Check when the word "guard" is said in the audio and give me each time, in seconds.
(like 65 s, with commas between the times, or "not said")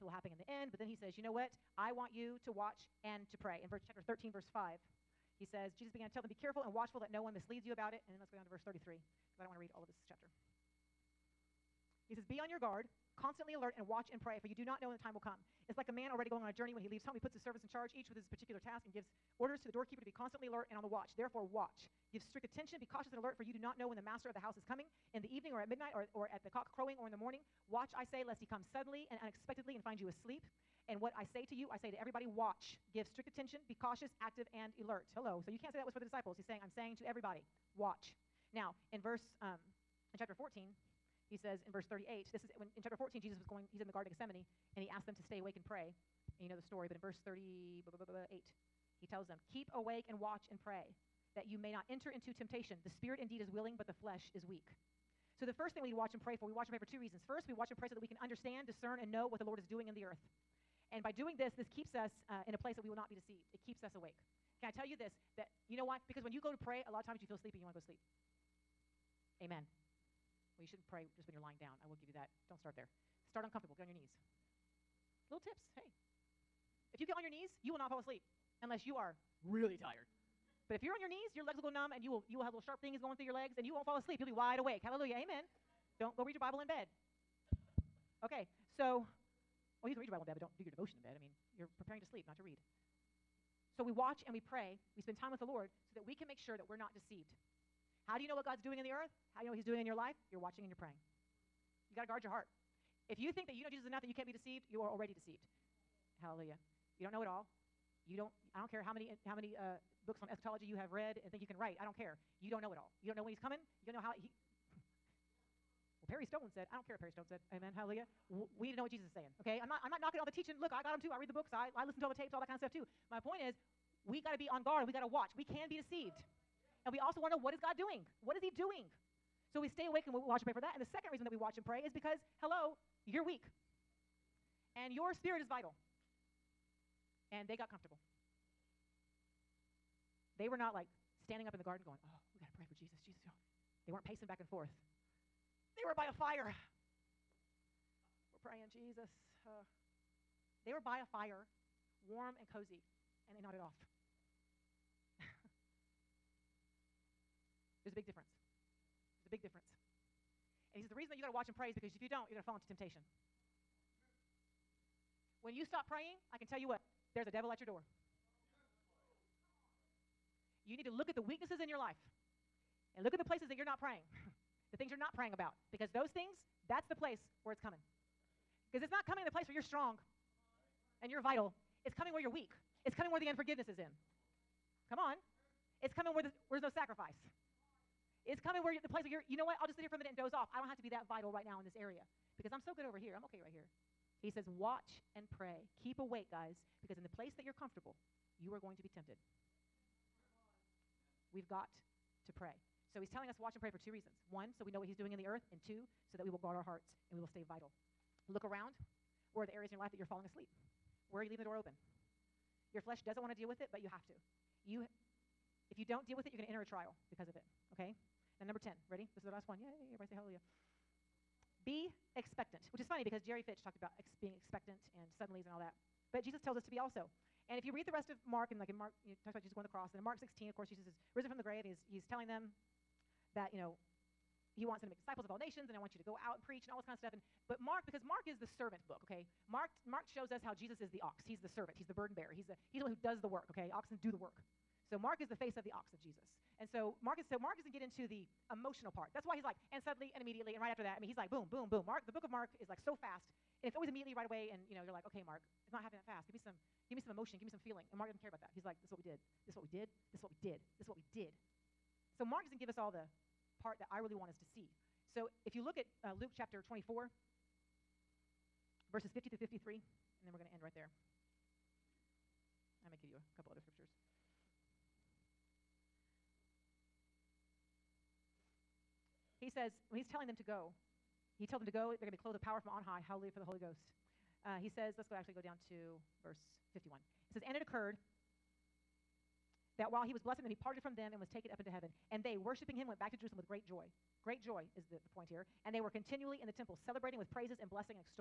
12 s, 102 s, 124 s, 206 s.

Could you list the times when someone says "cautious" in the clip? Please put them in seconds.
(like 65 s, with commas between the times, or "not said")
22 s, 33 s.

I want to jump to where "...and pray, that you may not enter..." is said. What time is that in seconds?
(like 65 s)
50 s.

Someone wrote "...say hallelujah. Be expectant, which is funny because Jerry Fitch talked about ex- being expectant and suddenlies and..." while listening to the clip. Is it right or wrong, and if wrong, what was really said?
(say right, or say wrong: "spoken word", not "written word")
right.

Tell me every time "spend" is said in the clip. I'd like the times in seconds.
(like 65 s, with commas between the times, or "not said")
95 s.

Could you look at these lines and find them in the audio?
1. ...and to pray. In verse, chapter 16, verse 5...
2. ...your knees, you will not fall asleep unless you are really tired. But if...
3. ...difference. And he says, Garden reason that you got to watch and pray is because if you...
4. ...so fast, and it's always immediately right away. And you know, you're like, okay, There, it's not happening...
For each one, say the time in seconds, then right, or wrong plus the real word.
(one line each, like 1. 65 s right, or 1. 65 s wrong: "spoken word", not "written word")
1. 3 s wrong: "13", not "16"
2. 77 s right
3. 159 s wrong: "The", not "Garden"
4. 252 s wrong: "Mark", not "There".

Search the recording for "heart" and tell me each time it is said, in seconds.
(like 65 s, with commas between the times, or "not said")
102 s, 206 s.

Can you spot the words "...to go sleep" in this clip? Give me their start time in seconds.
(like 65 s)
67 s.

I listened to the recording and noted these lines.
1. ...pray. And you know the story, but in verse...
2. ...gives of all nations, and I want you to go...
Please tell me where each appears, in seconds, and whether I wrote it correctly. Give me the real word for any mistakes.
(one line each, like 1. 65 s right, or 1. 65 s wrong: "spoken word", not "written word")
1. 45 s right
2. 234 s wrong: "disciples", not "gives".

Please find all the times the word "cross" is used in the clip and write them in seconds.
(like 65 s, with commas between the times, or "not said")
229 s.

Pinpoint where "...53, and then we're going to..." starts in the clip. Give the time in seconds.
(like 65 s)
269 s.